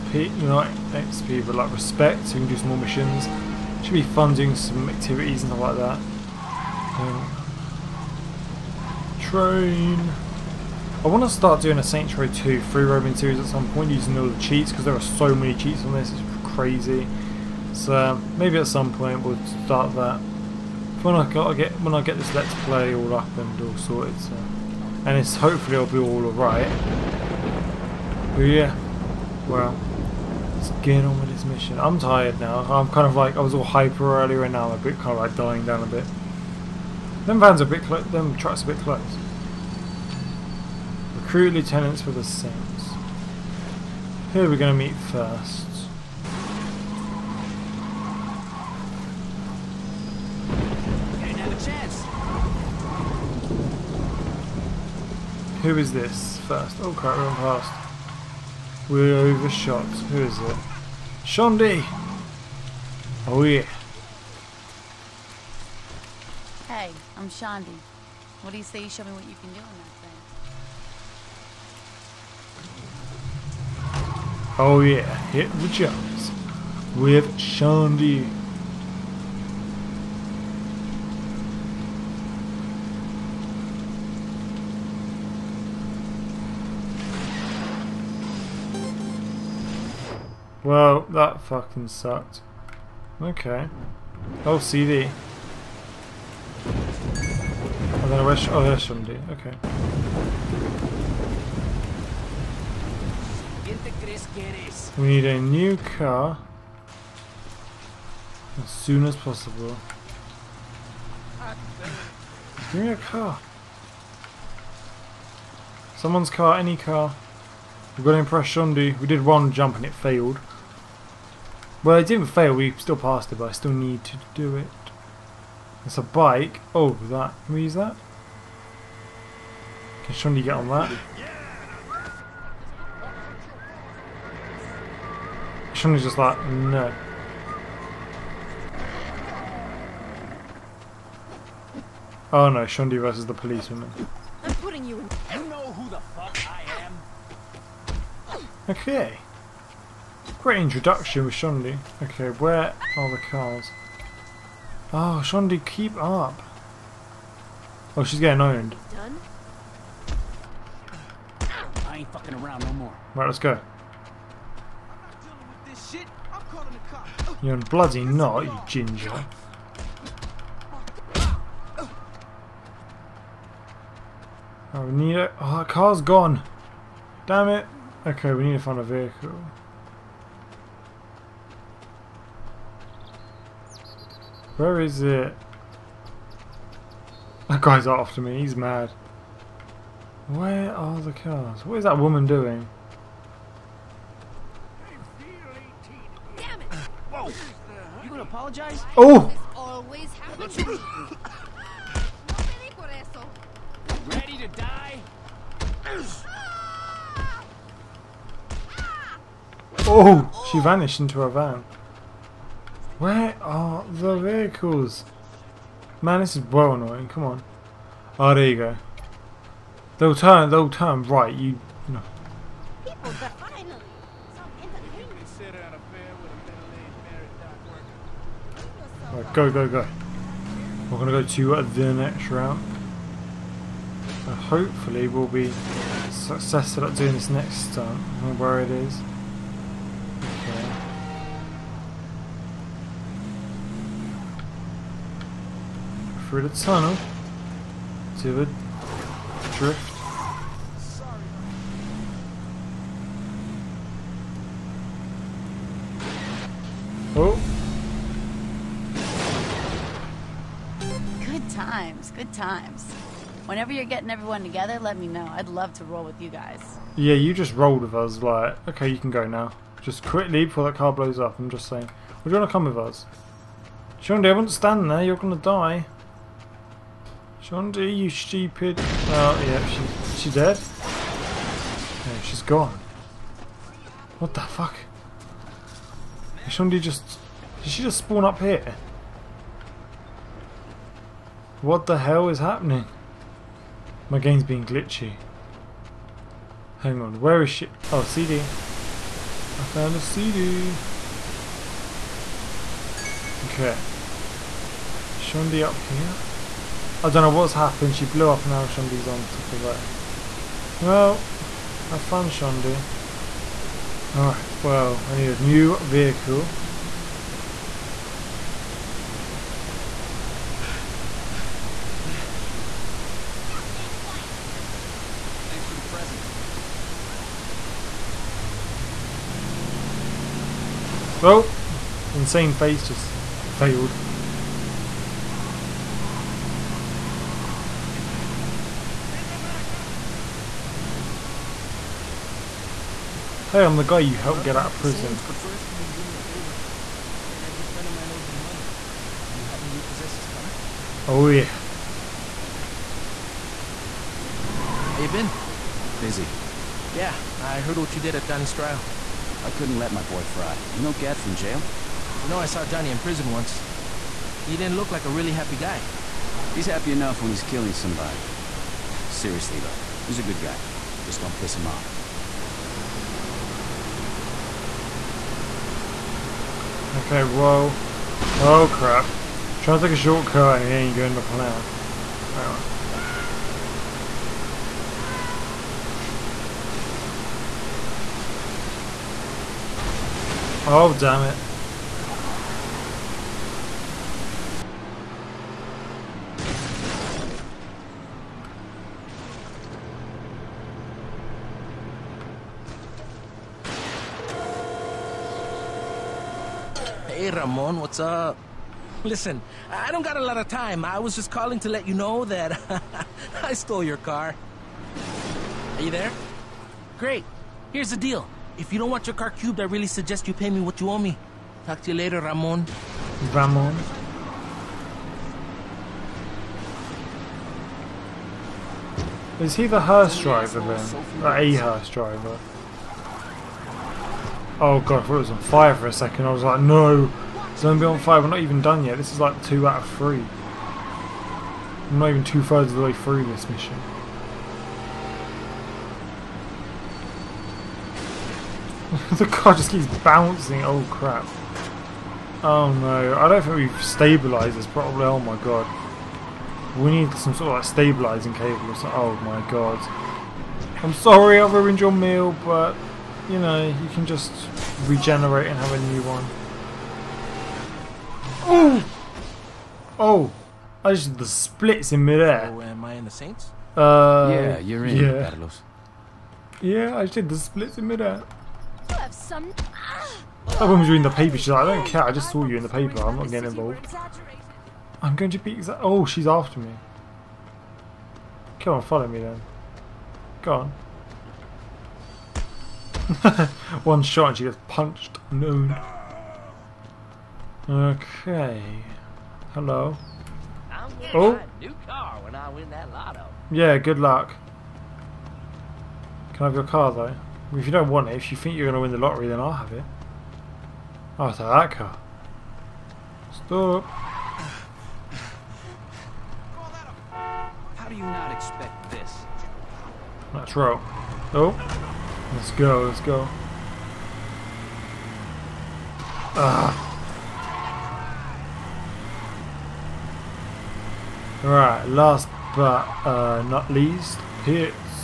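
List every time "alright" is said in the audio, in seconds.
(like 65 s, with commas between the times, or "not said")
26 s, 314 s, 531 s.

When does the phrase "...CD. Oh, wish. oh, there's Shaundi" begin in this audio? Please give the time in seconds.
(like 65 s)
94 s.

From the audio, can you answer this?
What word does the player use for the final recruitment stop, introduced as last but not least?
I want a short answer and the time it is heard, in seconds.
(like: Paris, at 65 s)
Pits, at 534 s.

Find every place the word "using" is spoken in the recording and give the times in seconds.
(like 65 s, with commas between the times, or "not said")
13 s.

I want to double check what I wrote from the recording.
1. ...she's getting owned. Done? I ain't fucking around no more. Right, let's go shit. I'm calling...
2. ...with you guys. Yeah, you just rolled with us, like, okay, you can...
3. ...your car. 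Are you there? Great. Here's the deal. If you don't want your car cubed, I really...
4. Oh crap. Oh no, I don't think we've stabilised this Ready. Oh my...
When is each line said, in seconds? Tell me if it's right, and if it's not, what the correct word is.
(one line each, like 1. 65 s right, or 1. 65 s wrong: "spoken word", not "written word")
1. 158 s right
2. 266 s right
3. 413 s right
4. 450 s wrong: "Probably", not "Ready".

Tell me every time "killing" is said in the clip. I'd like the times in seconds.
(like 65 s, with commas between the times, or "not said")
367 s.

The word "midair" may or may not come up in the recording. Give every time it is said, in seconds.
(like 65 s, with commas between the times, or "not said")
472 s, 477 s.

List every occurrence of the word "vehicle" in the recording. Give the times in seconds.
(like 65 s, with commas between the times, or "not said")
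178 s, 214 s, 315 s.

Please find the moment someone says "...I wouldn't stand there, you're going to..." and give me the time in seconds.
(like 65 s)
274 s.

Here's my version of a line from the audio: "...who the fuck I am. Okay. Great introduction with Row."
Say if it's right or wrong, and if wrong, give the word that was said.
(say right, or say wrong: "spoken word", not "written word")
wrong: "Shaundi", not "Row".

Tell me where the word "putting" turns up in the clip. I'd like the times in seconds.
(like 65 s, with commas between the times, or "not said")
144 s.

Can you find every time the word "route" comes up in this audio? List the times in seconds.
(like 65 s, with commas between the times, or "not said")
232 s.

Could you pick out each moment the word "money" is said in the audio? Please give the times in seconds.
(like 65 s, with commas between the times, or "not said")
348 s.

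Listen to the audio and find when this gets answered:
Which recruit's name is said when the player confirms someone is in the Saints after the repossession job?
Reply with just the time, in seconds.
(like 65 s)
475 s.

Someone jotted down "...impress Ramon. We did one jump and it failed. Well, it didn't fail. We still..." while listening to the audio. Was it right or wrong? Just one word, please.
wrong.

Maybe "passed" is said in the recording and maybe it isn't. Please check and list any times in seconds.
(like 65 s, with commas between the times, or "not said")
122 s.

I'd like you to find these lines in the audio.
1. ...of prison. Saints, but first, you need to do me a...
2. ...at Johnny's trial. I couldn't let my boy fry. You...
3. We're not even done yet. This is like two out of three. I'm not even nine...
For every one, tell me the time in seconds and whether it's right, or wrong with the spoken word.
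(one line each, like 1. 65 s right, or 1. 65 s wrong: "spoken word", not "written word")
1. 344 s right
2. 358 s right
3. 438 s wrong: "two", not "nine".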